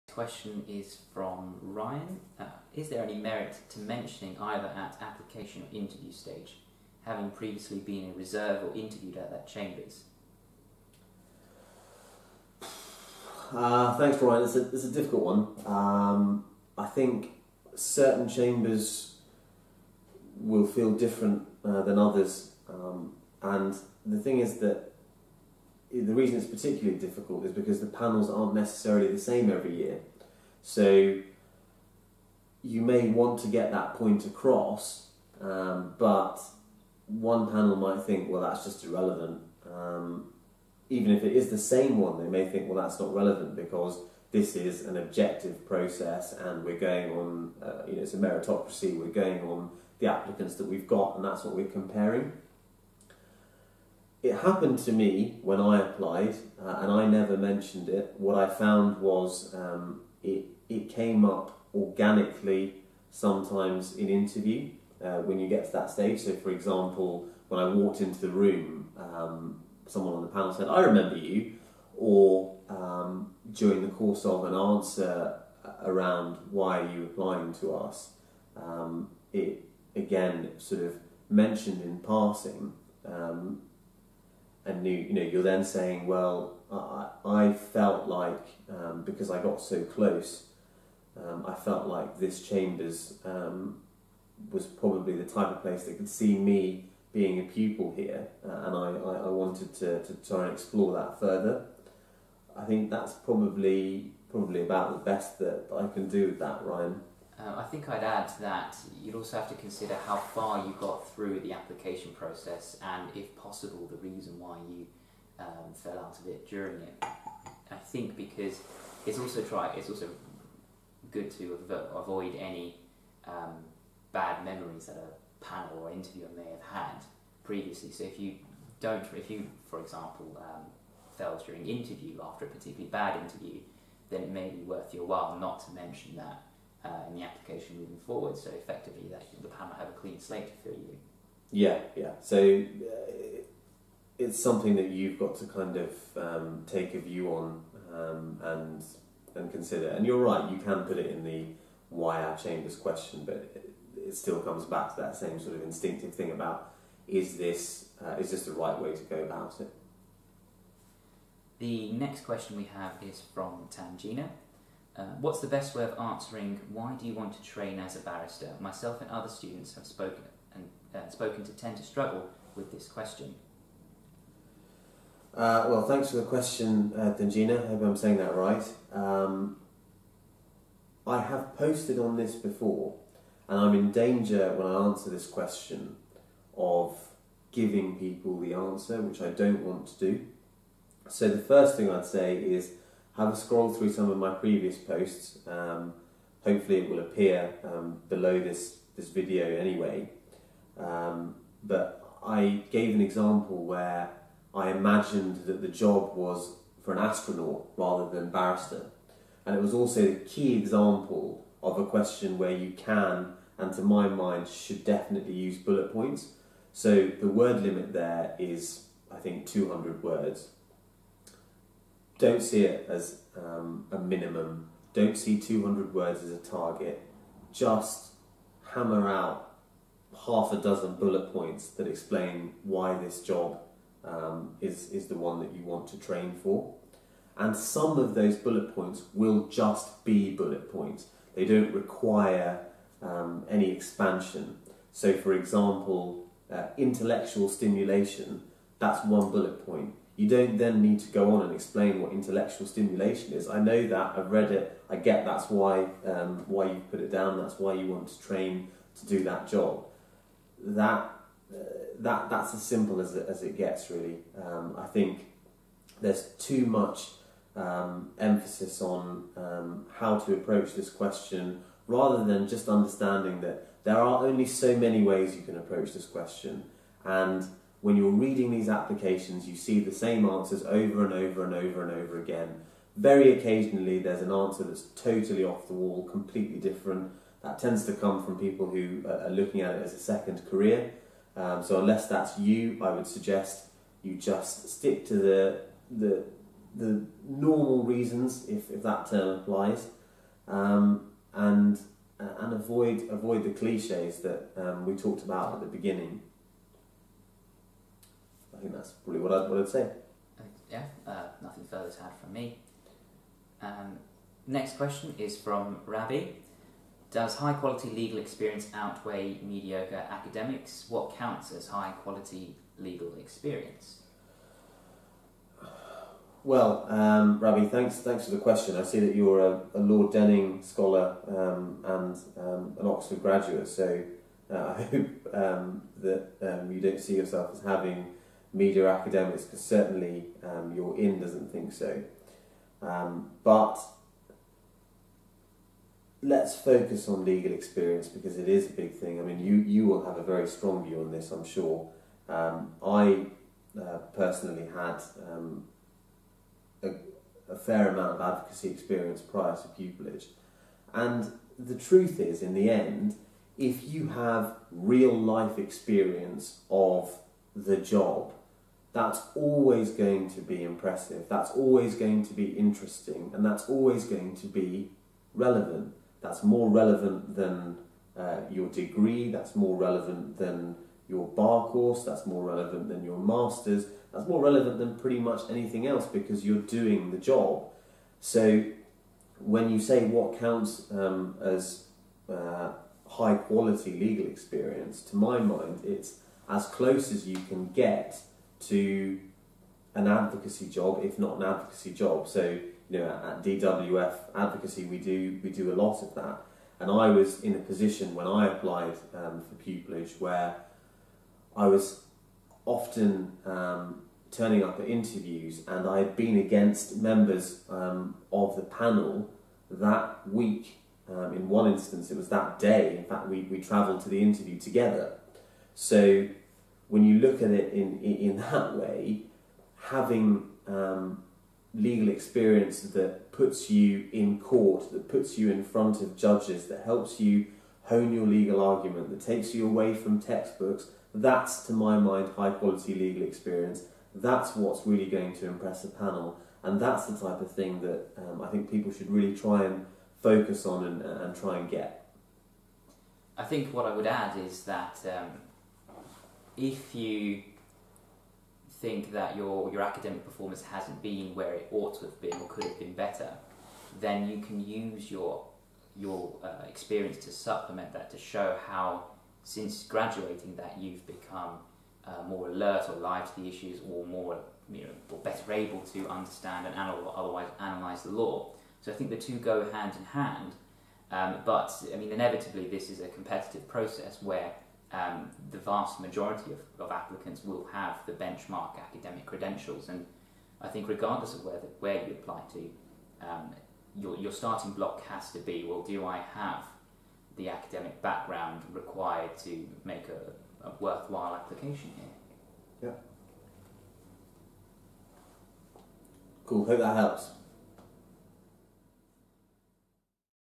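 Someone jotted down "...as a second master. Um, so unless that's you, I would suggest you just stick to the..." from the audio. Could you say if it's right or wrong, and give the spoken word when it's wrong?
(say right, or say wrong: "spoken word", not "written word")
wrong: "career", not "master".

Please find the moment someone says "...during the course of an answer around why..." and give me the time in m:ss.
1:13.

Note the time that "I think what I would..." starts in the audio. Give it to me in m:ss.
7:33.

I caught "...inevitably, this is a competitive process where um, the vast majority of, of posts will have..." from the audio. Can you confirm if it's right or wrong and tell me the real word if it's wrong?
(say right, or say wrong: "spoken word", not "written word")
wrong: "applicants", not "posts".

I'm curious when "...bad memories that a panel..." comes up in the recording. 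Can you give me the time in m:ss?
2:04.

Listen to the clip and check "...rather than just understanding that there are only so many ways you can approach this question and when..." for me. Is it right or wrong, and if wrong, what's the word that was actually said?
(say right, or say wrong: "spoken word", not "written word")
right.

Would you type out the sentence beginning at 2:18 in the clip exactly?
So effectively, that the panel have a clean slate for you.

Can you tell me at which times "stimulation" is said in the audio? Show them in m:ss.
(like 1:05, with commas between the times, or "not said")
4:07, 4:12.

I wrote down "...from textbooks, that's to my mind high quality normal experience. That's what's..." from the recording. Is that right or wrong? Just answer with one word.
wrong.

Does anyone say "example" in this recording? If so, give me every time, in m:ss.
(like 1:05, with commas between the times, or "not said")
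1:06, 2:09, 3:23, 3:30, 4:05.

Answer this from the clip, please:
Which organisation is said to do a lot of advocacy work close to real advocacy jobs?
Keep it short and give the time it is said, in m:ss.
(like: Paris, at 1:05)
DWF Advocacy, at 6:43.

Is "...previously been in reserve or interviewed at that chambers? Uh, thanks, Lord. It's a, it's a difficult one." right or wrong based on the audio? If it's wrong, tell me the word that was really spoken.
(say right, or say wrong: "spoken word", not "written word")
wrong: "Ryan", not "Lord".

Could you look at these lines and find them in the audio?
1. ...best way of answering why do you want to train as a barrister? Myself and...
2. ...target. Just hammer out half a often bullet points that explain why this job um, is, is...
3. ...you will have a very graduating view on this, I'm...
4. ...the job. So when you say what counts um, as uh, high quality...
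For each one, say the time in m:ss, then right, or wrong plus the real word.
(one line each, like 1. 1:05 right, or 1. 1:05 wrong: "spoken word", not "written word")
1. 2:45 right
2. 3:46 wrong: "dozen", not "often"
3. 5:49 wrong: "strong", not "graduating"
4. 6:27 right.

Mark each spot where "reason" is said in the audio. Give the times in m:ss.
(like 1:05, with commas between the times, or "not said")
0:26, 1:54, 4:57.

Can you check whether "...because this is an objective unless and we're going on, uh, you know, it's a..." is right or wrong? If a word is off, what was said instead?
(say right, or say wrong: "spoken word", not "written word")
wrong: "process", not "unless".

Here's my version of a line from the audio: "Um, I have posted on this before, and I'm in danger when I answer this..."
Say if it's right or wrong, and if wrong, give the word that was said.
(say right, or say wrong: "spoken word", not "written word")
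right.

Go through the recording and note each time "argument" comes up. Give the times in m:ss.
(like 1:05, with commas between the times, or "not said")
7:18.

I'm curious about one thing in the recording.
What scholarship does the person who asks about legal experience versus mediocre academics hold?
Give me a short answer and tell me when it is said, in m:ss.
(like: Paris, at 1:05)
Lord Denning scholar, at 5:29.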